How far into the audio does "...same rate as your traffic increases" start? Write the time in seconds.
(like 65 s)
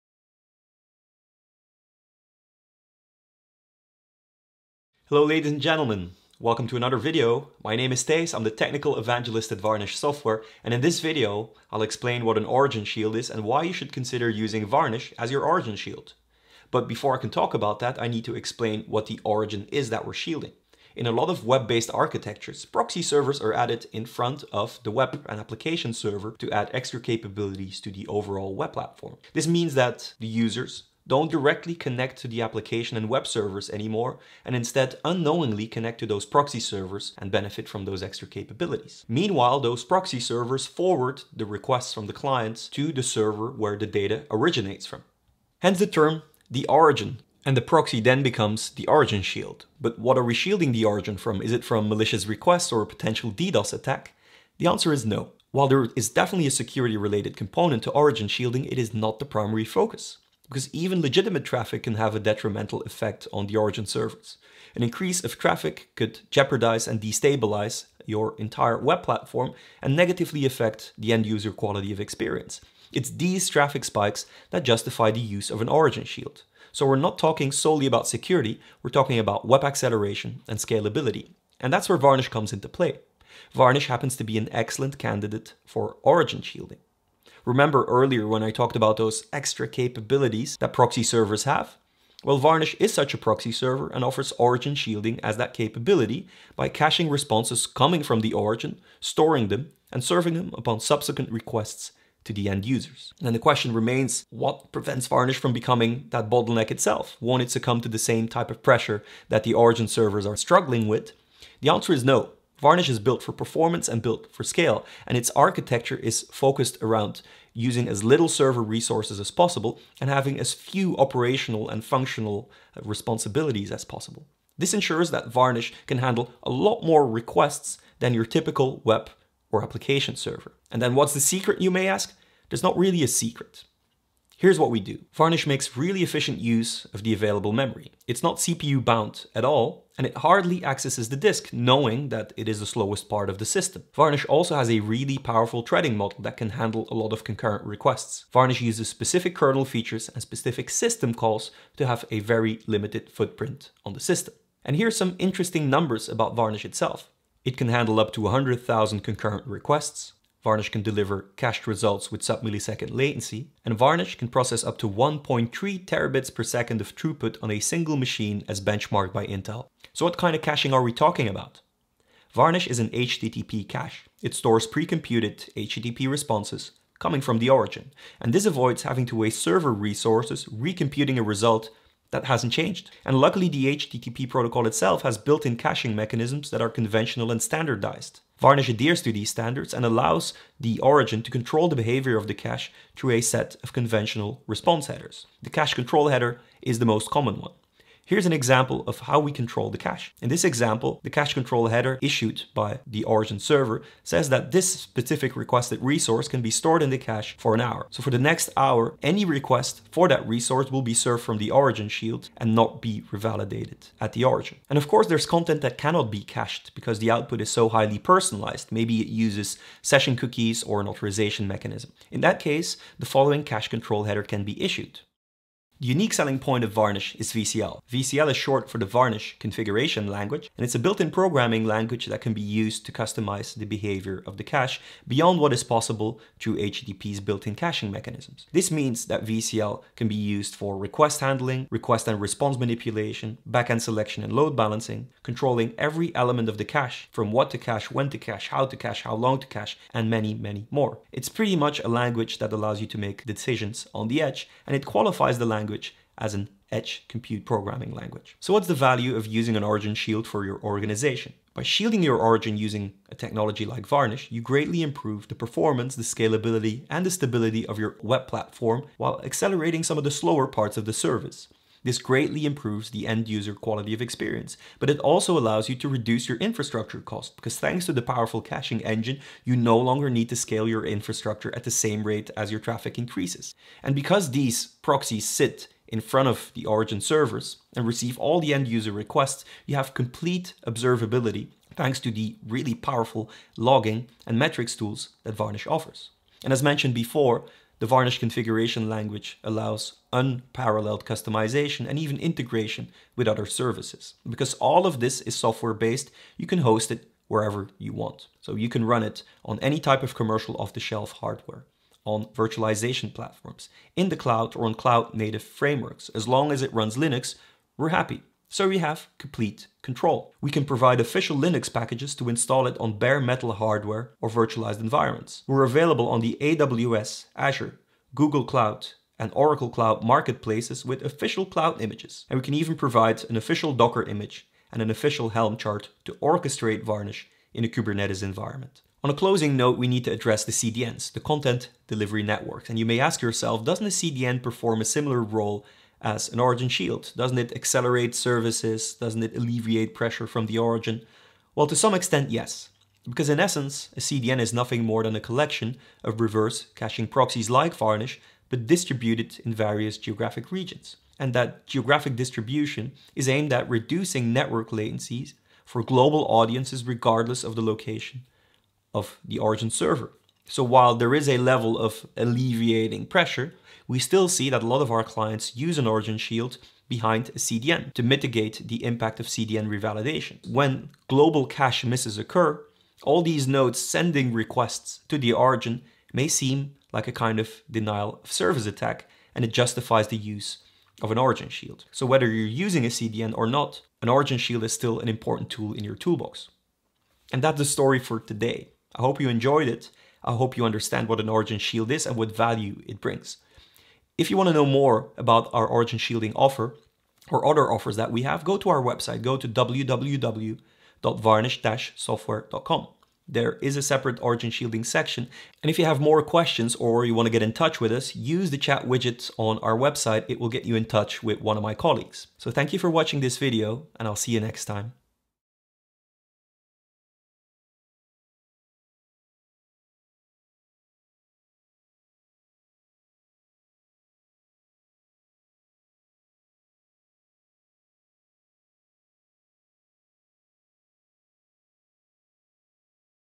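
281 s.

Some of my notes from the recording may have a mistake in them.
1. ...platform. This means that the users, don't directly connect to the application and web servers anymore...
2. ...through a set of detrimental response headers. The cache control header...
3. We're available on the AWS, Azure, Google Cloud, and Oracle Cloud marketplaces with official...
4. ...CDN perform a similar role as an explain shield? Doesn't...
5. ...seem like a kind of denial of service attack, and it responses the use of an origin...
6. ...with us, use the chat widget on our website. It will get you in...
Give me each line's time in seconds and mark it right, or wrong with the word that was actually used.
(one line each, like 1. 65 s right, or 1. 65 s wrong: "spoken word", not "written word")
1. 28 s right
2. 192 s wrong: "conventional", not "detrimental"
3. 325 s right
4. 343 s wrong: "origin", not "explain"
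5. 386 s wrong: "justifies", not "responses"
6. 417 s right.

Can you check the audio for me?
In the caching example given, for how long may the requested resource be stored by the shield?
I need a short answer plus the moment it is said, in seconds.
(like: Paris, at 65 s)
an hour, at 207 s.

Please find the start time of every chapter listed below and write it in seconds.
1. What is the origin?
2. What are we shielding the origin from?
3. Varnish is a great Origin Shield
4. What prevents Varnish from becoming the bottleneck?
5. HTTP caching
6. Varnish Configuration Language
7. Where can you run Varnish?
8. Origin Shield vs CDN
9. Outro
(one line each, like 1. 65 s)
1. 16 s
2. 49 s
3. 81 s
4. 103 s
5. 169 s
6. 225 s
7. 304 s
8. 339 s
9. 397 s.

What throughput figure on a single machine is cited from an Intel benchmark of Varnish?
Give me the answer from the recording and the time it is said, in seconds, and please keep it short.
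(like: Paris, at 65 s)
1.3 terabits per second, at 164 s.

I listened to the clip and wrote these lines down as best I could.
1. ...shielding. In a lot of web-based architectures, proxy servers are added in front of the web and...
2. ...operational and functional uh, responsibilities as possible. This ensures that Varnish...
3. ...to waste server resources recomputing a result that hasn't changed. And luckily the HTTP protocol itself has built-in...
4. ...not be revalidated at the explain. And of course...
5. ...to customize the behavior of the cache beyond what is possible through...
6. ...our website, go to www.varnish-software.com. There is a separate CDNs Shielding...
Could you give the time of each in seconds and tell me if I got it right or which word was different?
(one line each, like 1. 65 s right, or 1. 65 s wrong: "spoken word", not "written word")
1. 20 s right
2. 120 s right
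3. 179 s right
4. 212 s wrong: "origin", not "explain"
5. 232 s right
6. 408 s wrong: "Origin", not "CDNs".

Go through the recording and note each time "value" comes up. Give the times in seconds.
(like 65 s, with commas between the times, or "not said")
258 s, 402 s.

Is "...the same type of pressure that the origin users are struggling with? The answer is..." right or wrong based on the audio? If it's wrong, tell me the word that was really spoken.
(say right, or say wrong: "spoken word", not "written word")
wrong: "servers", not "users".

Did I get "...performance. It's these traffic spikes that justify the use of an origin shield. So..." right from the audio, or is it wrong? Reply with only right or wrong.
wrong.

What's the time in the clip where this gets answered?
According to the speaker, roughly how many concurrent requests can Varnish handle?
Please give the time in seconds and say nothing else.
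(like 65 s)
158 s.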